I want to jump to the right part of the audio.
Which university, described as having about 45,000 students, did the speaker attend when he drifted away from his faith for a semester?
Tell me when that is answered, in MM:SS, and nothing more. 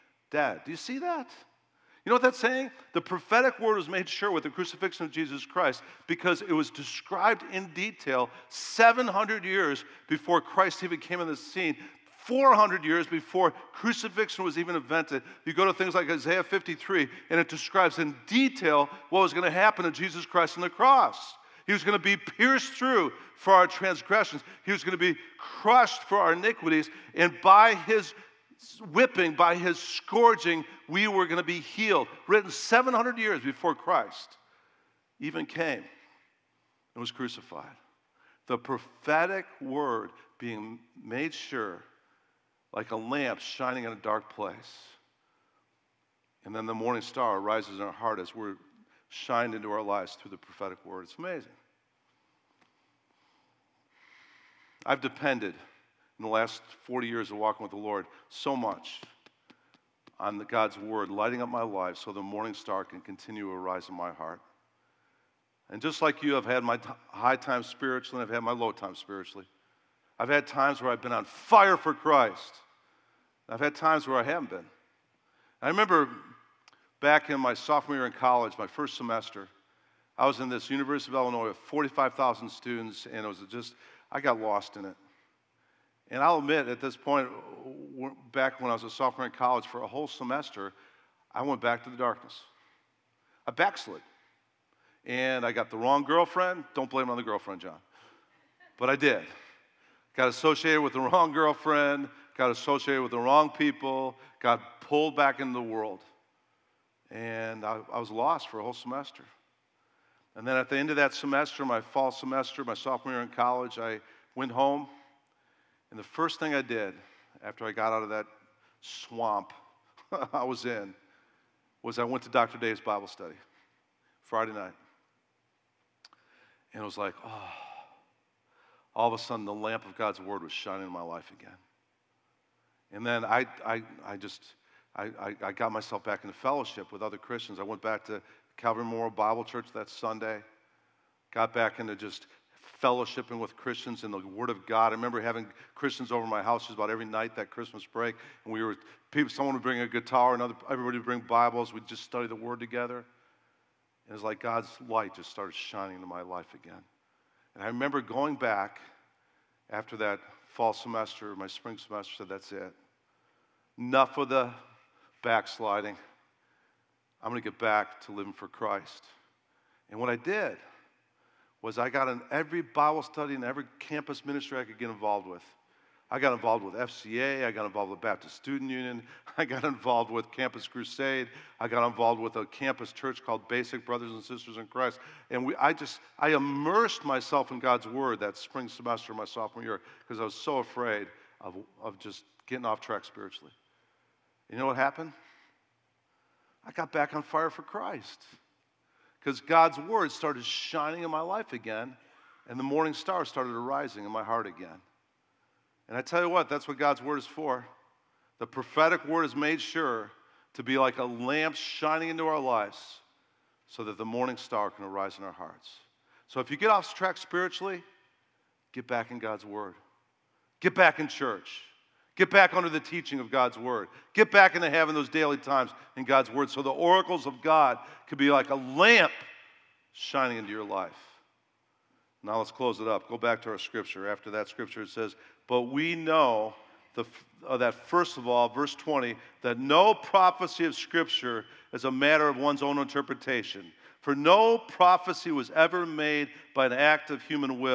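01:20.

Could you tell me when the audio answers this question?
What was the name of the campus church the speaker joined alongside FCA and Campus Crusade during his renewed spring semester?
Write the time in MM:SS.
03:03.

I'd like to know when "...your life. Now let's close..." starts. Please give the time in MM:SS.
03:50.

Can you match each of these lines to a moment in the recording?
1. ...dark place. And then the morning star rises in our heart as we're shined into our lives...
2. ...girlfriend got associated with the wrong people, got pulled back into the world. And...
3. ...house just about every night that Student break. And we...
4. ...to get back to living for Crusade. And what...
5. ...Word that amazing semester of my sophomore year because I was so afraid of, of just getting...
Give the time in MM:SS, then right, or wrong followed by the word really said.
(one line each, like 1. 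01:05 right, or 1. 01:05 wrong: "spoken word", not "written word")
1. 00:43 right
2. 01:41 right
3. 02:26 wrong: "Christmas", not "Student"
4. 02:47 wrong: "Christ", not "Crusade"
5. 03:07 wrong: "spring", not "amazing".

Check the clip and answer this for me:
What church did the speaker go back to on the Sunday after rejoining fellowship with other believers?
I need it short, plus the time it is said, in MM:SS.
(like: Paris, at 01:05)
Calvary Memorial Bible Church, at 02:18.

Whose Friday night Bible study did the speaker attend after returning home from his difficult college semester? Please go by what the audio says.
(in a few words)
Dr. Day.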